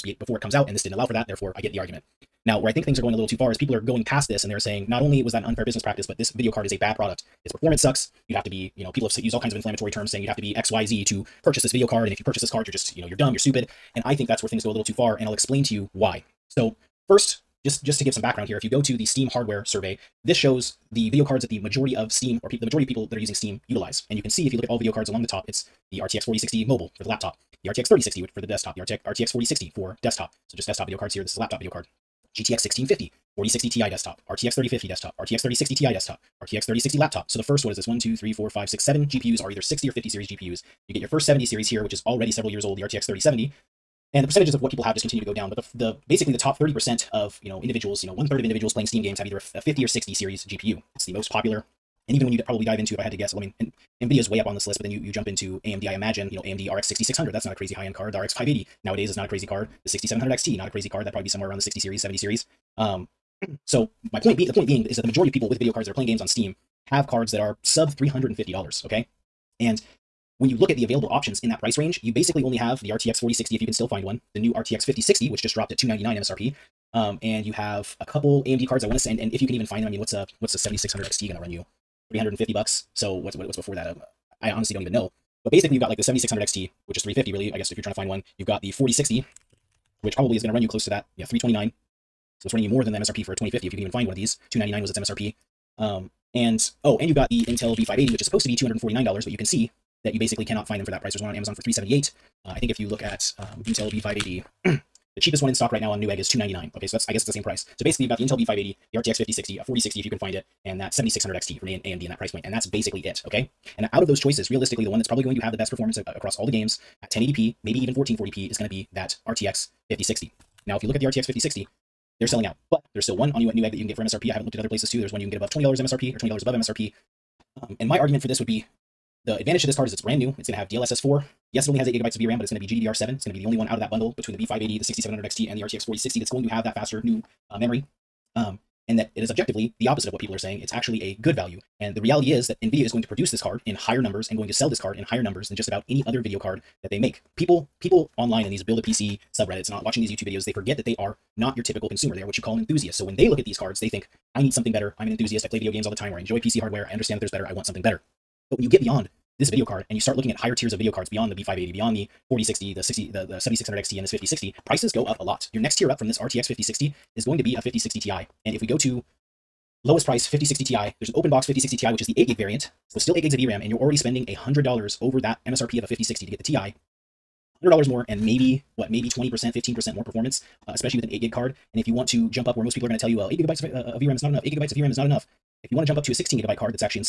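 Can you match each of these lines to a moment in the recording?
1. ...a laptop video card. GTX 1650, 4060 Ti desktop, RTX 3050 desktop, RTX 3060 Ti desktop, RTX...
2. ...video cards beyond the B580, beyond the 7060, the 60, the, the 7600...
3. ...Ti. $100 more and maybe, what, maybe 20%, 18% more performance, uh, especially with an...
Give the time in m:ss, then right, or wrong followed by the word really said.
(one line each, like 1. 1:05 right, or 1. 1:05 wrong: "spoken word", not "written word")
1. 0:31 right
2. 2:40 wrong: "4060", not "7060"
3. 2:56 wrong: "15", not "18".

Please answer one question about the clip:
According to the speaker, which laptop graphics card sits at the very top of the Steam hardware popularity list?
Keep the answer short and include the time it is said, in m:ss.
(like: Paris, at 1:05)
RTX 4060 mobile, at 0:25.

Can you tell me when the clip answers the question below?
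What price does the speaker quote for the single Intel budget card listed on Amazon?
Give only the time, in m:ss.
1:41.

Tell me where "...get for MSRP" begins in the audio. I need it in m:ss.
2:03.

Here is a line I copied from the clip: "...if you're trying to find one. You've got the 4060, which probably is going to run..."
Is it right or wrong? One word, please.
right.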